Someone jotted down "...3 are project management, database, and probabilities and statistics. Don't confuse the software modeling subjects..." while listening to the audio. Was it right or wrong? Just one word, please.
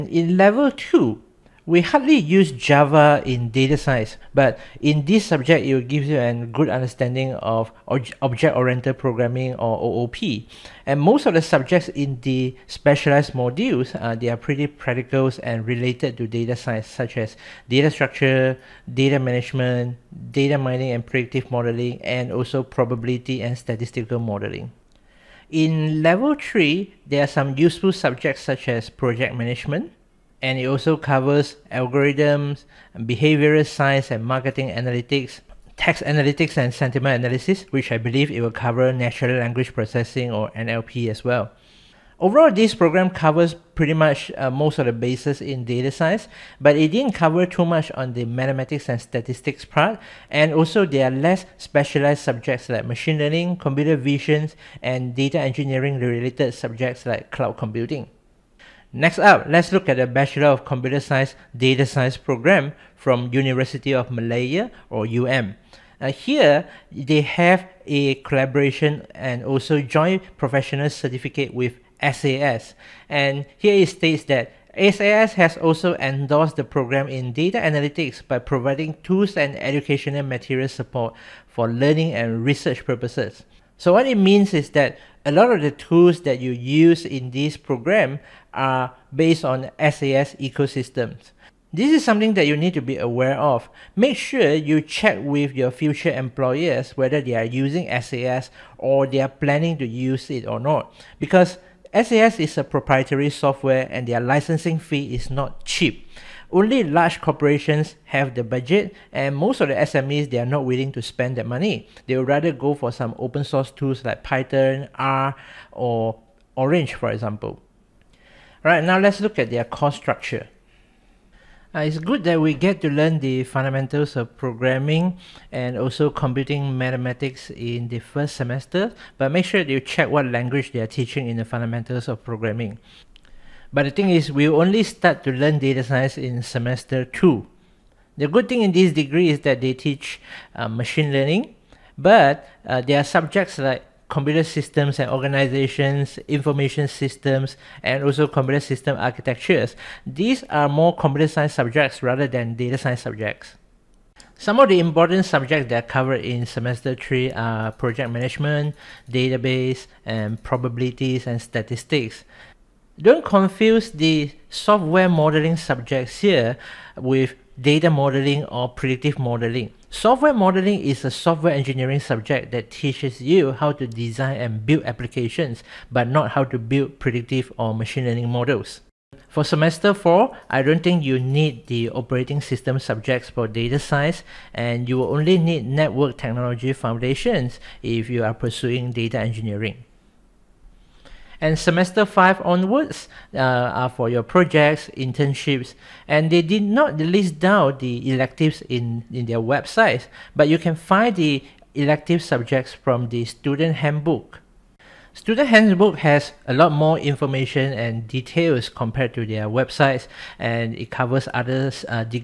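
right.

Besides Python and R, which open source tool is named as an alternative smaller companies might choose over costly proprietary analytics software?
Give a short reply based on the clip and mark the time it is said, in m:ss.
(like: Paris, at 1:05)
Orange, at 1:56.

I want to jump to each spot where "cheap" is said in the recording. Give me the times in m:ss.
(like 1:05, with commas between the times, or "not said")
1:45.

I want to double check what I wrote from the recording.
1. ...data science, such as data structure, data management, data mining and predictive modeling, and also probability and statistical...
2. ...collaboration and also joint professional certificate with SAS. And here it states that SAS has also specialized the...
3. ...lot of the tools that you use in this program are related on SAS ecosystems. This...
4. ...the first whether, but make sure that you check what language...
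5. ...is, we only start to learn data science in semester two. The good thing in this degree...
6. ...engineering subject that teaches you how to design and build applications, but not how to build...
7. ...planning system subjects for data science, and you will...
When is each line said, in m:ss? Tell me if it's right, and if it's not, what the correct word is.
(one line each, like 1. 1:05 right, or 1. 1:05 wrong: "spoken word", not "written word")
1. 0:16 right
2. 1:08 wrong: "endorsed", not "specialized"
3. 1:25 wrong: "based", not "related"
4. 2:07 wrong: "semester", not "whether"
5. 2:14 right
6. 2:51 right
7. 3:01 wrong: "operating", not "planning".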